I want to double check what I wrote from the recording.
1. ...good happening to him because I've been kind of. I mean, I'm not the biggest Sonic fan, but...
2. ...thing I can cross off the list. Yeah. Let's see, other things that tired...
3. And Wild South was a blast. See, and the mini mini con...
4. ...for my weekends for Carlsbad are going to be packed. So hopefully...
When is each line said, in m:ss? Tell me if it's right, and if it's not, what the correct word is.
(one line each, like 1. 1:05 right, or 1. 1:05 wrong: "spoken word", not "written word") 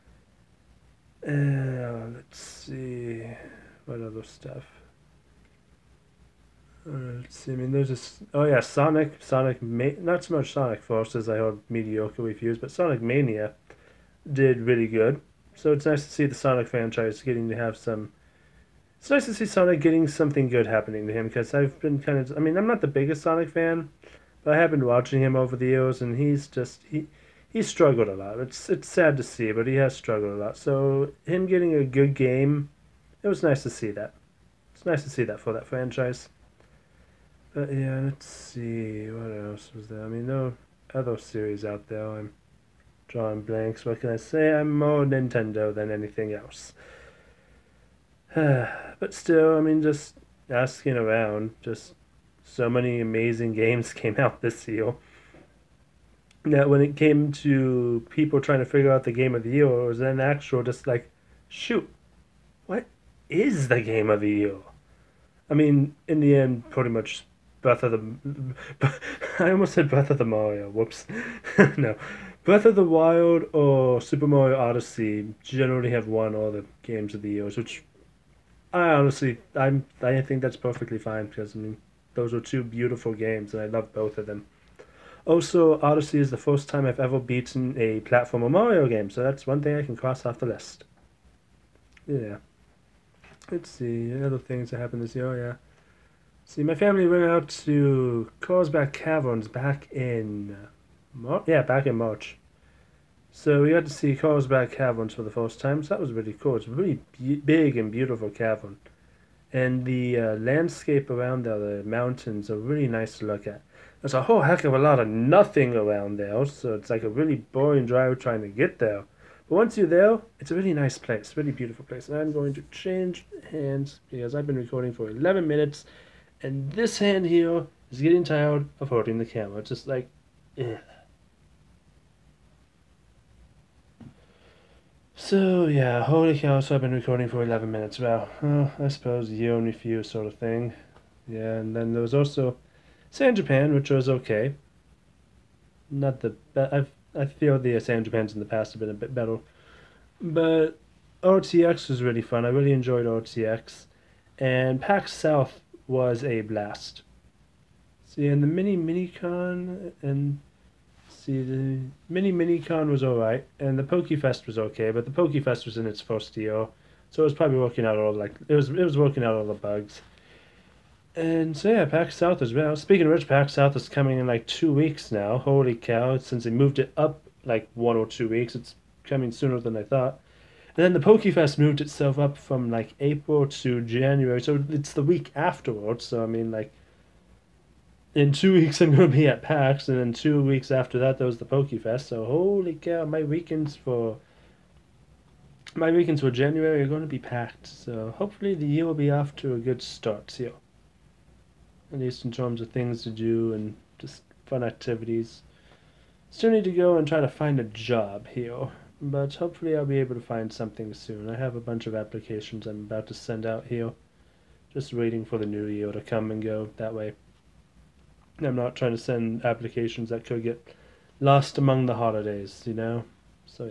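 1. 0:20 right
2. 1:29 wrong: "happened", not "tired"
3. 2:34 wrong: "PAX", not "Wild"
4. 3:13 wrong: "January", not "Carlsbad".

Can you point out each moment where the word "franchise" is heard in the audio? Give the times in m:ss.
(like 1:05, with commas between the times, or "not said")
0:16, 0:35.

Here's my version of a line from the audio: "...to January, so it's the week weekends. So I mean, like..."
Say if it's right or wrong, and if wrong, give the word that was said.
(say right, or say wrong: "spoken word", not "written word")
wrong: "afterwards", not "weekends".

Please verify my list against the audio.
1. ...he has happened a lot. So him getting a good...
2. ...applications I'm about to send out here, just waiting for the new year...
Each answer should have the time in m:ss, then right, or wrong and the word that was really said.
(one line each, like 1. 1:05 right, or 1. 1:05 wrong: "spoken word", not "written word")
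1. 0:29 wrong: "struggled", not "happened"
2. 3:31 right.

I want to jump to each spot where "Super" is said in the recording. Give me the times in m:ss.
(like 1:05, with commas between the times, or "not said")
1:13.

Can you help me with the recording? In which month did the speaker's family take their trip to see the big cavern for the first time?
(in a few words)
March.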